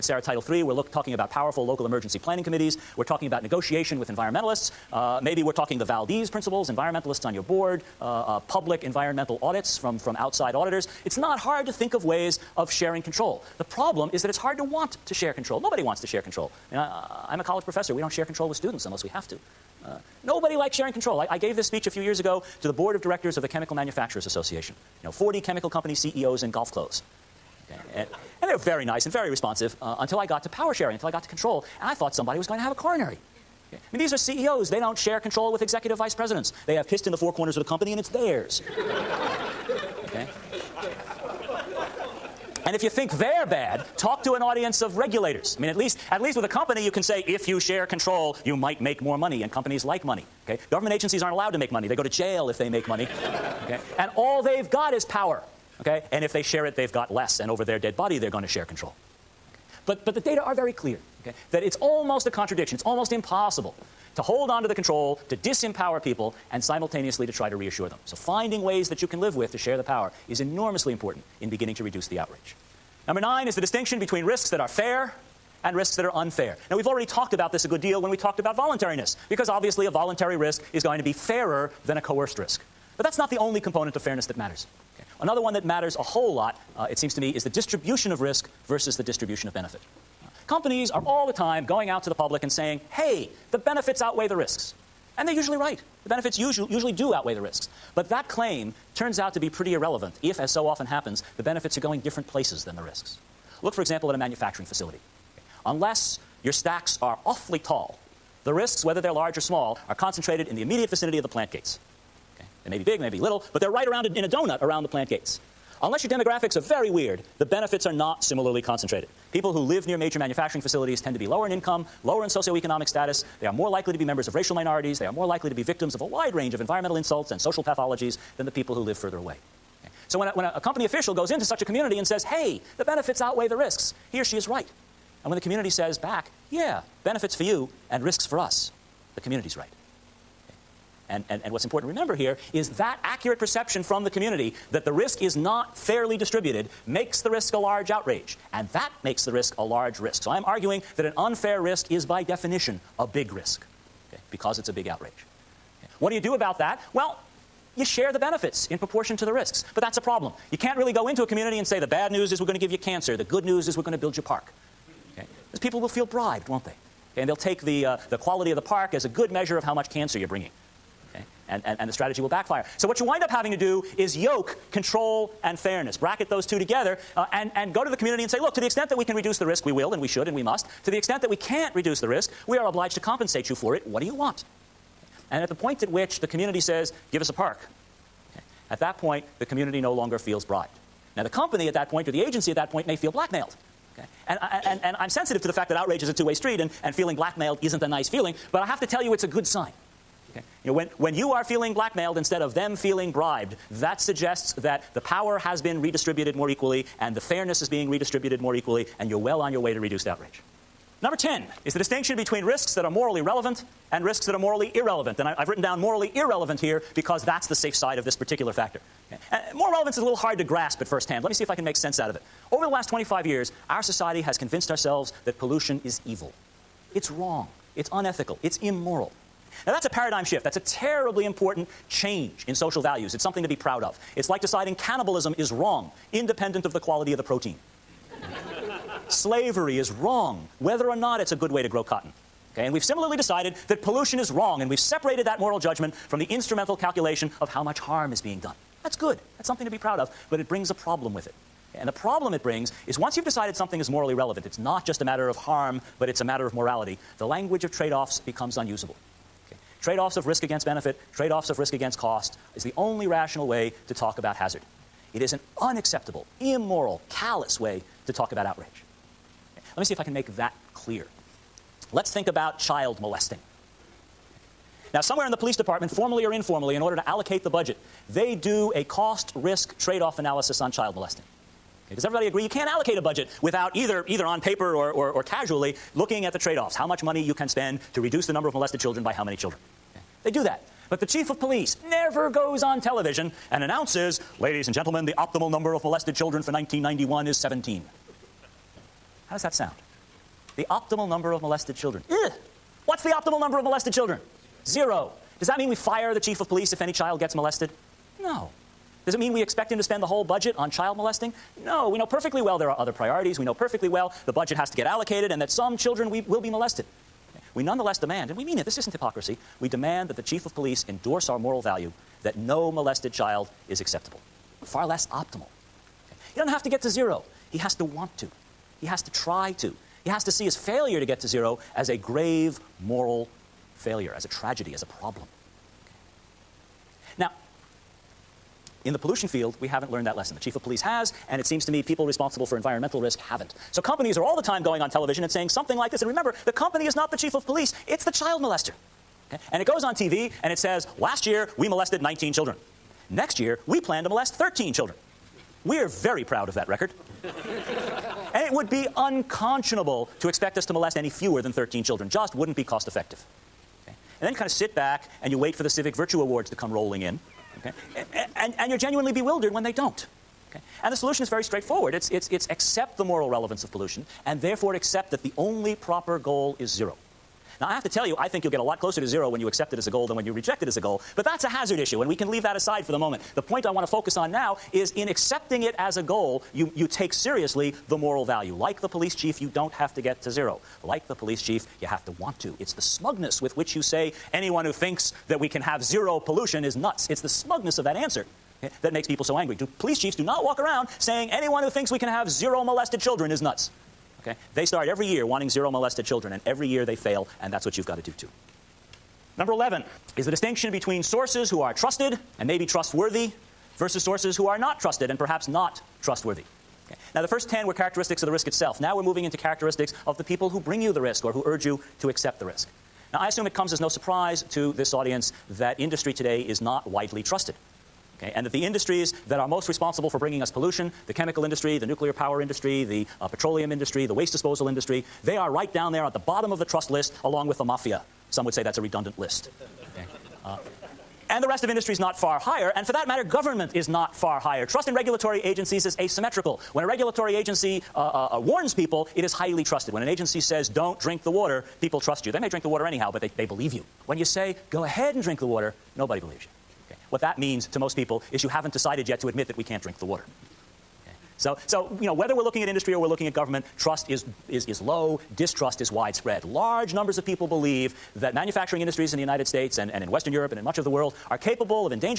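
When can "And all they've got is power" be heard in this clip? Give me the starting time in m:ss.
0:53.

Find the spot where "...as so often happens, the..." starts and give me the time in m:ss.
1:40.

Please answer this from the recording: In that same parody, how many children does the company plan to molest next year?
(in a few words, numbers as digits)
13.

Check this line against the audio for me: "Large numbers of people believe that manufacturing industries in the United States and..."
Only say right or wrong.
right.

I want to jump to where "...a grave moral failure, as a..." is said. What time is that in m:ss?
5:31.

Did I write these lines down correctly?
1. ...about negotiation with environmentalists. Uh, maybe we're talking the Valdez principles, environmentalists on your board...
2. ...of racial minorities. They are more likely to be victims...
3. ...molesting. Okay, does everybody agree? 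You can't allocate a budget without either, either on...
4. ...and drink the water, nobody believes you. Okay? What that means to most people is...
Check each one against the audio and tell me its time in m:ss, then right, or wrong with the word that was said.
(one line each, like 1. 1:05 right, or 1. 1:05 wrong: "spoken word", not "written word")
1. 0:03 right
2. 2:04 right
3. 4:40 right
4. 7:35 right.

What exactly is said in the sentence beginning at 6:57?
Now, the first 10 were characteristics of the risk itself.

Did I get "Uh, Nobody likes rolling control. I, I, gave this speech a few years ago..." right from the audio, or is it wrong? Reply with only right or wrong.
wrong.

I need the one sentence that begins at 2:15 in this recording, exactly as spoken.
And when the community says back, yeah, benefits for you and risks for us.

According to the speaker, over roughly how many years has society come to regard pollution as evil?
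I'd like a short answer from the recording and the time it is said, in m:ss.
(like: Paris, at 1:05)
25 years, at 3:42.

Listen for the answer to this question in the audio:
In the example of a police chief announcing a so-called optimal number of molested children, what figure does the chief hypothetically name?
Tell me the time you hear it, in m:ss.
4:57.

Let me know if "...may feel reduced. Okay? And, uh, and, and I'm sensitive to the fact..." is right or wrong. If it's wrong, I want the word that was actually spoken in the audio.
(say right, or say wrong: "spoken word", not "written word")
wrong: "blackmailed", not "reduced".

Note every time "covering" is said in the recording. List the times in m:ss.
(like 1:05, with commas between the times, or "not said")
not said.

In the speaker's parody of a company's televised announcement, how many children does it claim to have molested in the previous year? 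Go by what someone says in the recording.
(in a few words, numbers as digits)
19.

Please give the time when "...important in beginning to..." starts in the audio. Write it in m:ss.
1:10.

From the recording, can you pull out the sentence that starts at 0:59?
But, but the data are very clear okay, that it's almost a contradiction.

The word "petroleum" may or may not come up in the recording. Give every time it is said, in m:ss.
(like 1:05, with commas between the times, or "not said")
7:13.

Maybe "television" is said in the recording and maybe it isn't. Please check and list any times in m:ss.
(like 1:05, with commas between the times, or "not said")
4:52, 5:44.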